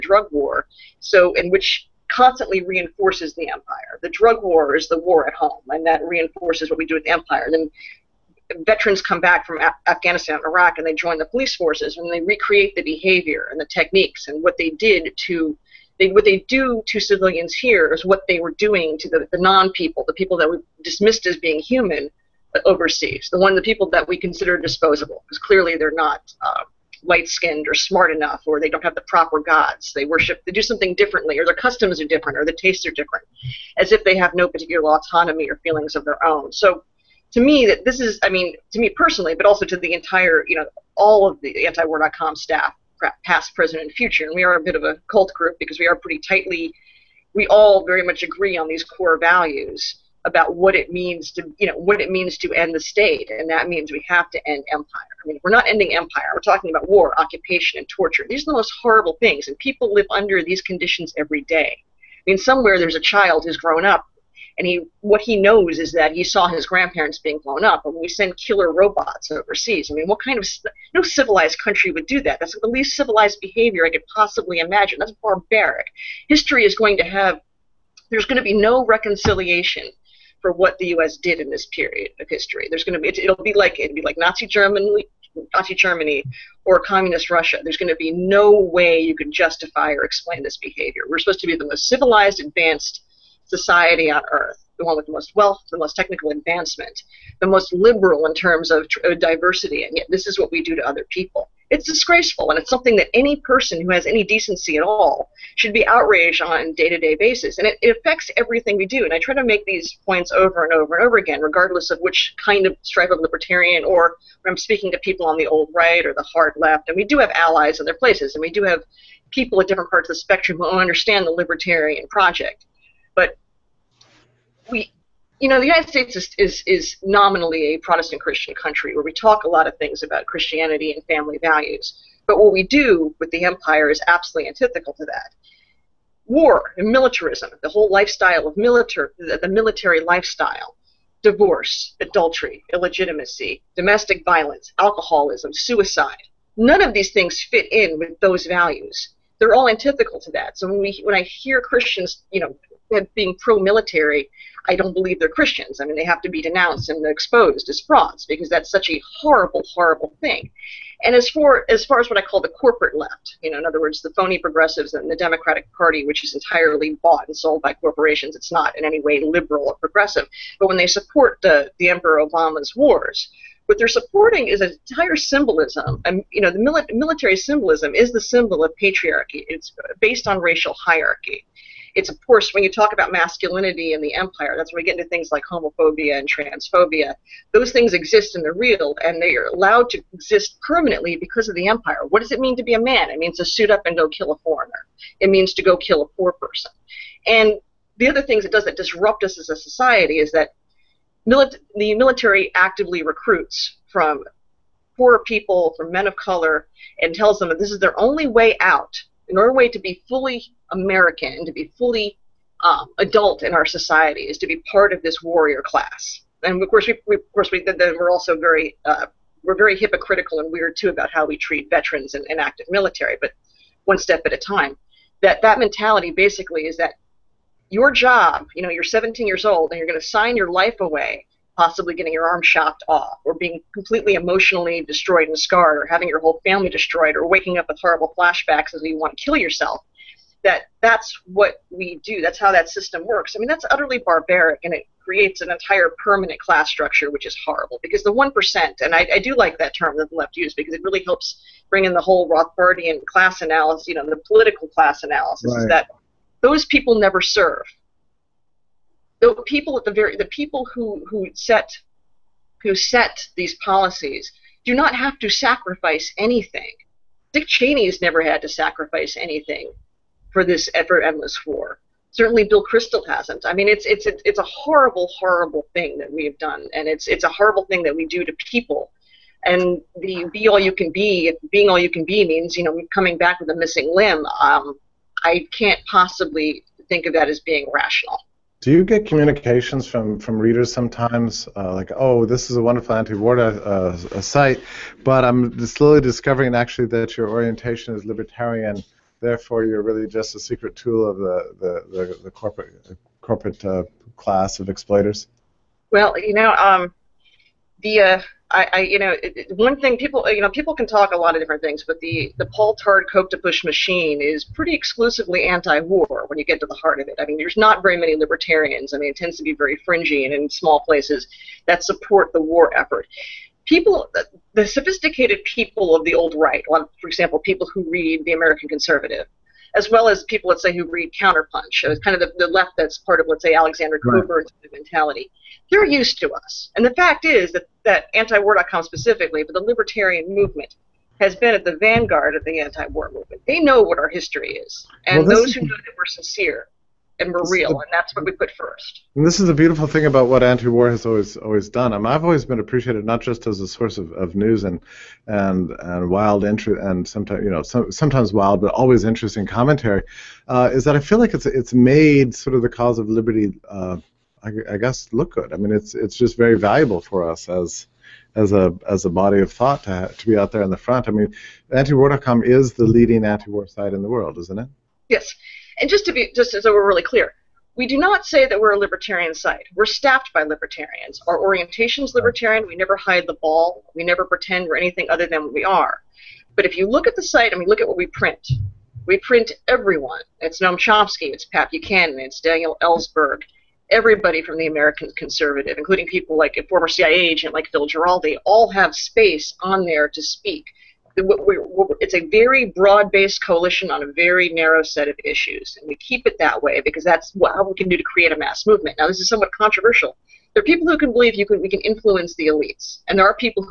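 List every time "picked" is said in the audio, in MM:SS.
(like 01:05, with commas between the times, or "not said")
not said.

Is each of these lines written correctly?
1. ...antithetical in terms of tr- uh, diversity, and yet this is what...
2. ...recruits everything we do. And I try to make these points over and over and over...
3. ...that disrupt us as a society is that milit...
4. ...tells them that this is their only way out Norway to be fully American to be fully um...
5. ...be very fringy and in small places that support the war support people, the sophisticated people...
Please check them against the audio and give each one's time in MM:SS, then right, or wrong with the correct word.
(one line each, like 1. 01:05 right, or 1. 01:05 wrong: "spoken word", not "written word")
1. 01:37 wrong: "liberal", not "antithetical"
2. 01:47 wrong: "affects", not "recruits"
3. 03:18 right
4. 03:27 right
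5. 05:19 wrong: "effort", not "support".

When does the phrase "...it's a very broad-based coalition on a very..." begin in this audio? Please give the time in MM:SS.
06:42.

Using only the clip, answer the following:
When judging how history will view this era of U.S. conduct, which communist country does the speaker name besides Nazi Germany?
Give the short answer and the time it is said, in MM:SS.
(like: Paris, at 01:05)
Russia, at 01:26.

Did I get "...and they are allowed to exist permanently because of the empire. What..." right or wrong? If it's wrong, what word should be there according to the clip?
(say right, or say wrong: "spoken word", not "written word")
right.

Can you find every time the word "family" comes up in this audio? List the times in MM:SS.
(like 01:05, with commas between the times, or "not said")
02:11, 03:56.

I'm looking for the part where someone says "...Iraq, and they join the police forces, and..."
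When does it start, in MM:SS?
00:10.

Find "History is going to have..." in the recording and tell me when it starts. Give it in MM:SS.
01:16.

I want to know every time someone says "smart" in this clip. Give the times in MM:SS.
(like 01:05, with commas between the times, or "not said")
00:27.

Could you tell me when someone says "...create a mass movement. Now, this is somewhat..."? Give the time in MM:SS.
06:48.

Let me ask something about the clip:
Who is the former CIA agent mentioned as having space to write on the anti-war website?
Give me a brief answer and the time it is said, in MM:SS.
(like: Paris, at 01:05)
Phil Giraldi, at 06:37.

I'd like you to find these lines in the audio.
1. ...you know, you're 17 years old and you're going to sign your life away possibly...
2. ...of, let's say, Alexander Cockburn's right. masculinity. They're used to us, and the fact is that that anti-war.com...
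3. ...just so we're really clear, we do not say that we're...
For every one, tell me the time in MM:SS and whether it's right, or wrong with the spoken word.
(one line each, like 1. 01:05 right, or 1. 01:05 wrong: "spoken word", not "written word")
1. 03:48 right
2. 05:33 wrong: "mentality", not "masculinity"
3. 06:16 right.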